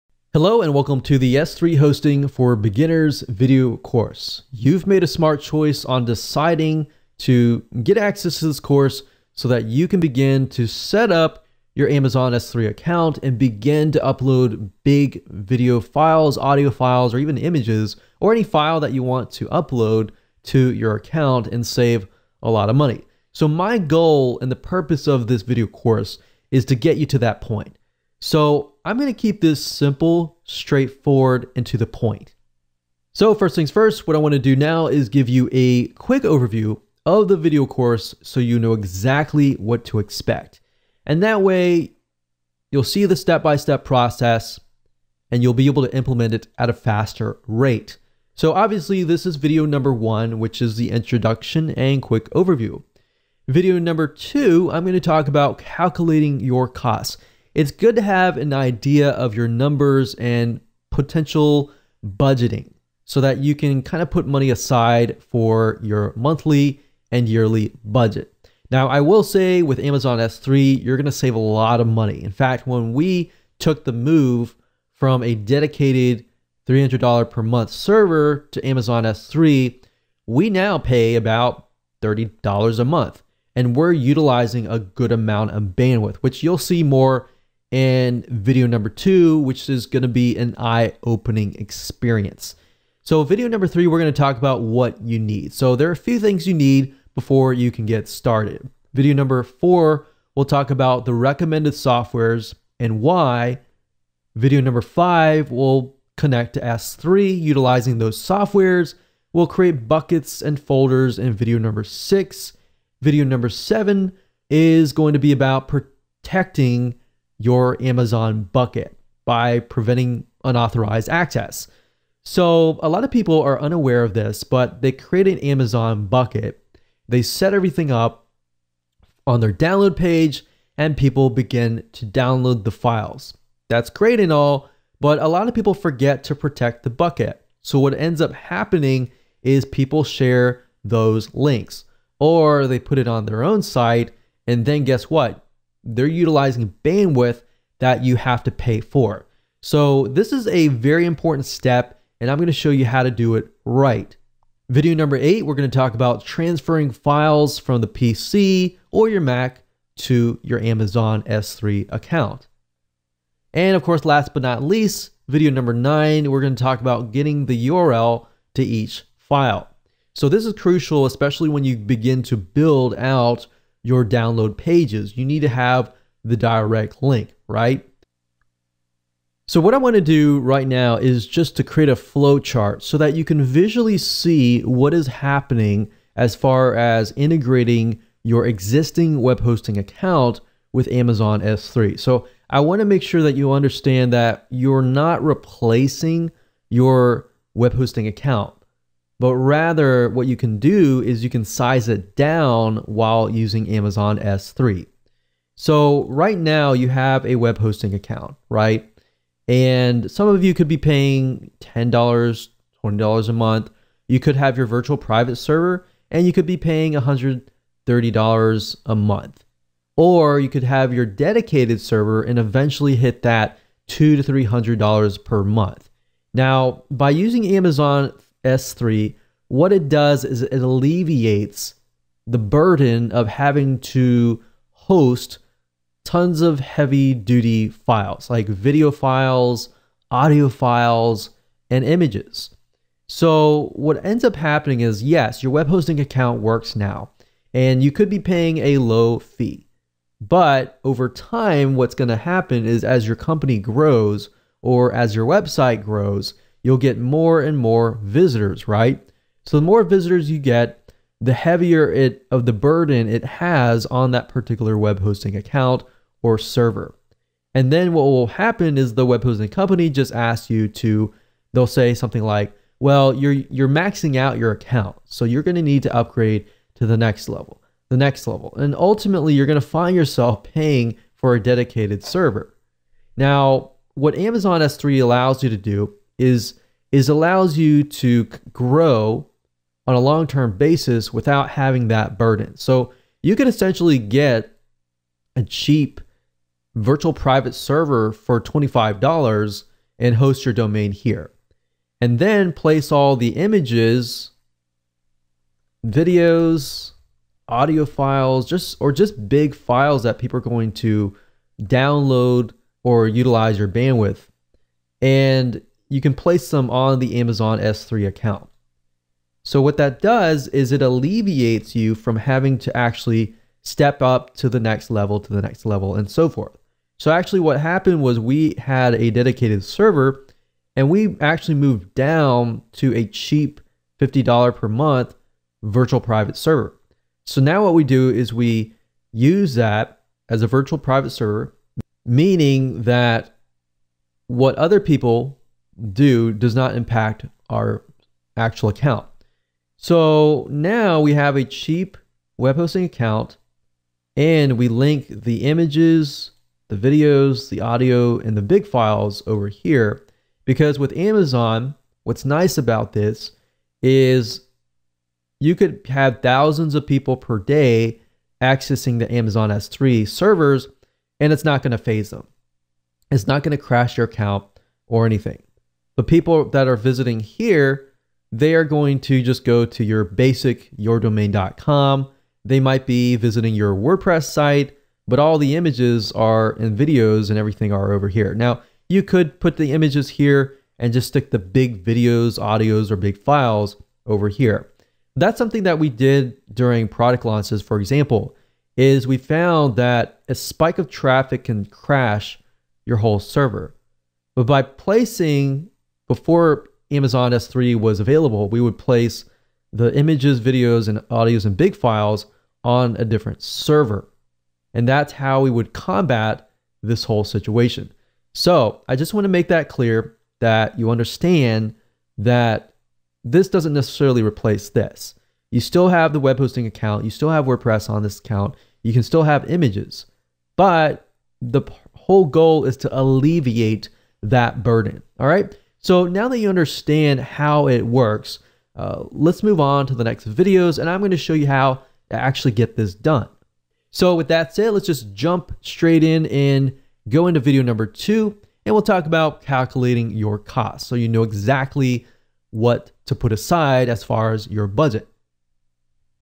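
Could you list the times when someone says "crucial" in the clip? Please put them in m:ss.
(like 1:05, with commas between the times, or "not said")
2:50.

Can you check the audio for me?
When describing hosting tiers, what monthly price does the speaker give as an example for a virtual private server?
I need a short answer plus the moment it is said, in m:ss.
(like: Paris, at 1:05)
$130, at 3:36.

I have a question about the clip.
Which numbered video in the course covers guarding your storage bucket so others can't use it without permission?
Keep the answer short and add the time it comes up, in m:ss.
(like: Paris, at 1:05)
7, at 1:53.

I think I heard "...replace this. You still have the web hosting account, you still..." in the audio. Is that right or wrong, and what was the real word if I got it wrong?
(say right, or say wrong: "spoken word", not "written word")
right.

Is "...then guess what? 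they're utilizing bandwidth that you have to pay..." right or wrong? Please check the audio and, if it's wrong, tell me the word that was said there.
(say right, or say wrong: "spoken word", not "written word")
right.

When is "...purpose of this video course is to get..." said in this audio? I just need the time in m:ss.
0:24.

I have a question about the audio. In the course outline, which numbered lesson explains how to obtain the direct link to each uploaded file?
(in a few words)
9.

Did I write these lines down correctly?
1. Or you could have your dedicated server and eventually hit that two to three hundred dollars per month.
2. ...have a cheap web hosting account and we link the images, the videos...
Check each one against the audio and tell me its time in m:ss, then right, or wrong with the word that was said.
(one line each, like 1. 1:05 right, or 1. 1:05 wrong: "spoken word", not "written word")
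1. 3:39 right
2. 5:51 right.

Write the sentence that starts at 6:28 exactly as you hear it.
Now, you could put the images here and just stick the big videos, audios, or big files over here.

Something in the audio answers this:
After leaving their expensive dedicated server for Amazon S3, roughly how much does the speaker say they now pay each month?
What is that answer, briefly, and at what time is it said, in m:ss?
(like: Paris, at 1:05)
$30, at 1:22.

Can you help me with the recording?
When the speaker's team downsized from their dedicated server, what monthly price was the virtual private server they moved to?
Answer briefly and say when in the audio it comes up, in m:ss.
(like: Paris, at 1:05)
$50, at 5:33.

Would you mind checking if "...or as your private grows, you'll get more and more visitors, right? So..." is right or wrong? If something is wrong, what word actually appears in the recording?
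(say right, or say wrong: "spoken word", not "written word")
wrong: "website", not "private".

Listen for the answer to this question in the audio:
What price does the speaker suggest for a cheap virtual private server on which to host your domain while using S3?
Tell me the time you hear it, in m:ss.
4:58.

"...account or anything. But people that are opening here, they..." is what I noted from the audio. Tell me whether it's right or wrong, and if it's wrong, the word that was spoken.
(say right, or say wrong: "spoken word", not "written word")
wrong: "visiting", not "opening".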